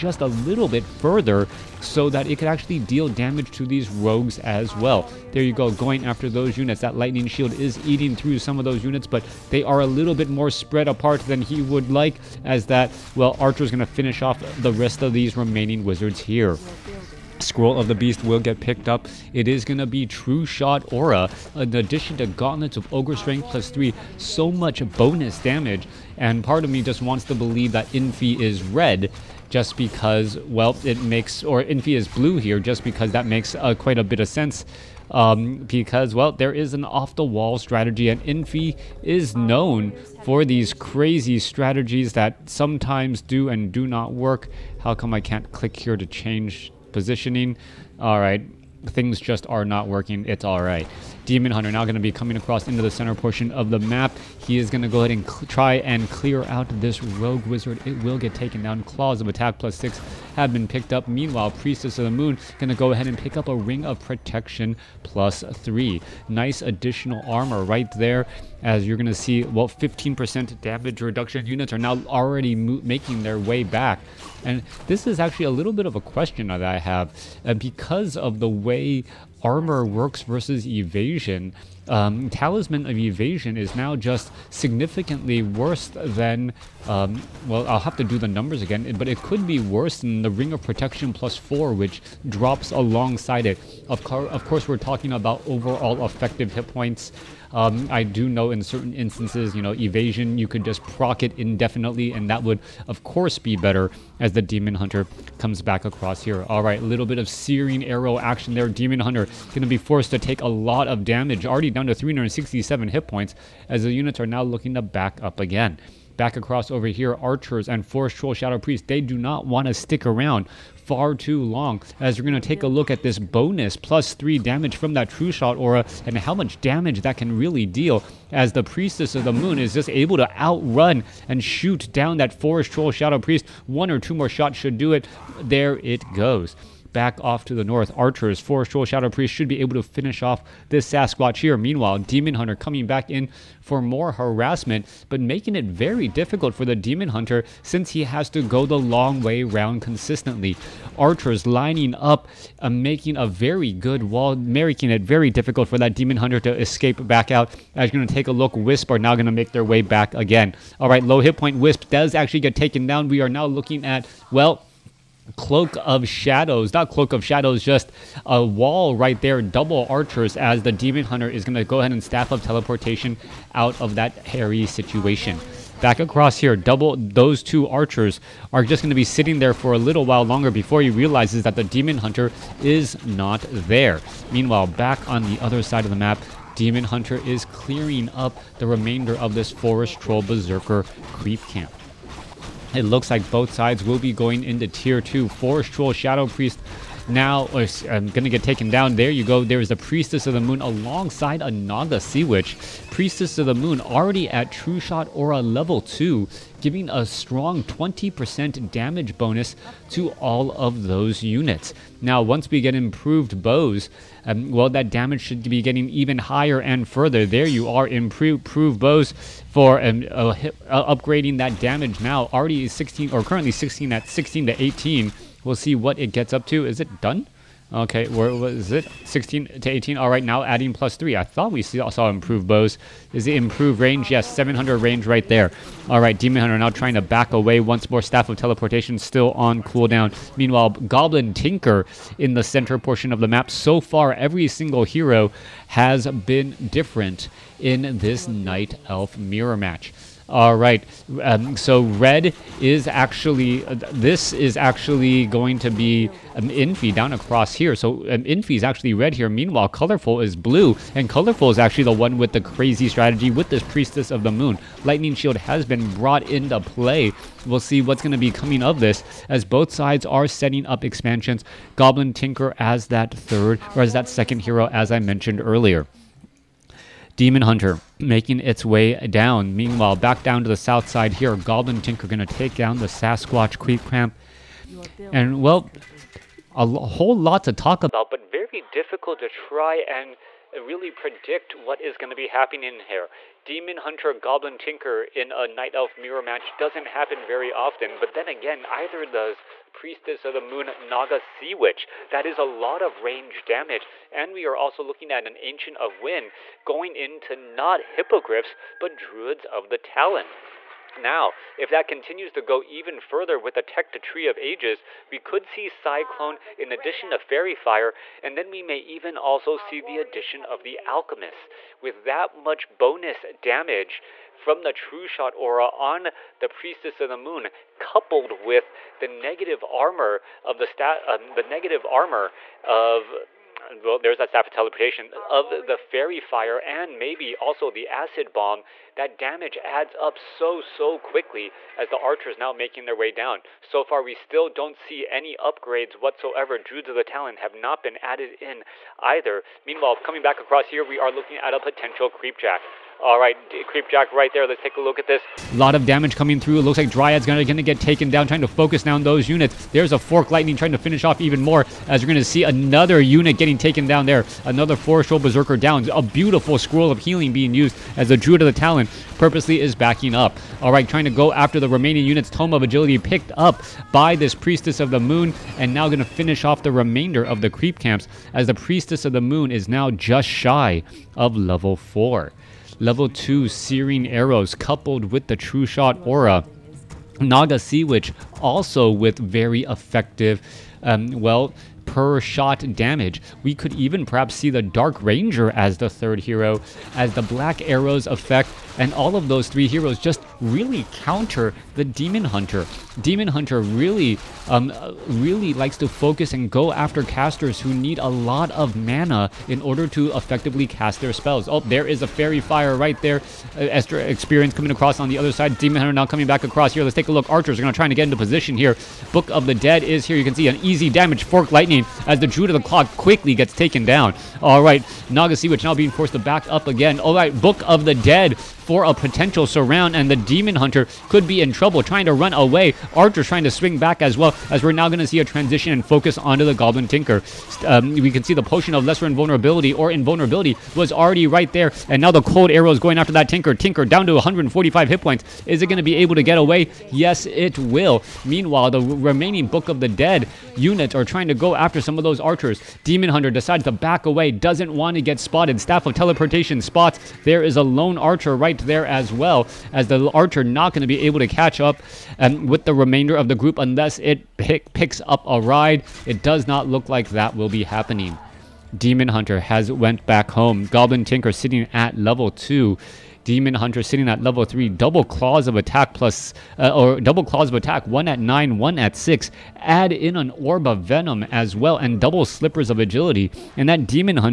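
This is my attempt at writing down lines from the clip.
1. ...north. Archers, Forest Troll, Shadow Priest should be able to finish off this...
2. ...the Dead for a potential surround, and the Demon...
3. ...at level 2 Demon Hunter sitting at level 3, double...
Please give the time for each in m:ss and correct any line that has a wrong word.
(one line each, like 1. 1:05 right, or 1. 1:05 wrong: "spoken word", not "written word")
1. 2:17 right
2. 7:07 right
3. 7:51 right.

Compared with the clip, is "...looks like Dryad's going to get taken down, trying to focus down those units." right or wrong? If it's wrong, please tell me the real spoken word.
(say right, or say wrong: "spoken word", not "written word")
right.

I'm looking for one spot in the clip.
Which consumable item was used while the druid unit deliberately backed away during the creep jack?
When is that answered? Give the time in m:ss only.
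6:06.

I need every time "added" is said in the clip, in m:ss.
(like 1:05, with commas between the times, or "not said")
5:47.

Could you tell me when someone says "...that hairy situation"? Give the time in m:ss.
2:53.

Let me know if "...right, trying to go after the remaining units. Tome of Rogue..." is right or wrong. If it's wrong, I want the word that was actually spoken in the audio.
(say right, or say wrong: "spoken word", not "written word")
wrong: "Agility", not "Rogue".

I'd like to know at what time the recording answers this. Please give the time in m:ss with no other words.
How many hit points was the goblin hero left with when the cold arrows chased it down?
7:24.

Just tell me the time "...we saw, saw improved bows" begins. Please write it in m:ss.
3:51.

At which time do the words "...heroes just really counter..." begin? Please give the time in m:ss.
6:39.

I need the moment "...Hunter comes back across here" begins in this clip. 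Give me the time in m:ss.
1:44.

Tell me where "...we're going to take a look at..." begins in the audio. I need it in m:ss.
2:02.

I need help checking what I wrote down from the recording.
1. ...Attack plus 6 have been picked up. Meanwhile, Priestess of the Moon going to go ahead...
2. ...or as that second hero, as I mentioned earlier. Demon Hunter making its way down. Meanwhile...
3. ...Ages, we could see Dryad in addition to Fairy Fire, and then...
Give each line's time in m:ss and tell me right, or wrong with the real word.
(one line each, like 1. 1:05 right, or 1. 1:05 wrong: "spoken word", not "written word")
1. 0:59 right
2. 4:33 right
3. 5:14 wrong: "Cyclone", not "Dryad".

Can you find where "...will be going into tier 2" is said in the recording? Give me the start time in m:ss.
3:13.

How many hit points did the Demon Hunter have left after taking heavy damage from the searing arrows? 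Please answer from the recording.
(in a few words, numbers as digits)
367.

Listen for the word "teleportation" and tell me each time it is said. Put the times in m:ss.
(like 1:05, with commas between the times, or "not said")
2:52, 3:58, 5:34, 7:35.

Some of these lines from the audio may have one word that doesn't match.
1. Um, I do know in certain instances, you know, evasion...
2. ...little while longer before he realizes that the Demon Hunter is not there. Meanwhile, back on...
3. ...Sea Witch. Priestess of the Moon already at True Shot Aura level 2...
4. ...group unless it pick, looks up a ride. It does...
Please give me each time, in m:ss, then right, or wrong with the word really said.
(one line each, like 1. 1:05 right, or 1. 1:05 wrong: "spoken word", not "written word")
1. 1:37 right
2. 2:59 right
3. 3:22 right
4. 7:43 wrong: "picks", not "looks".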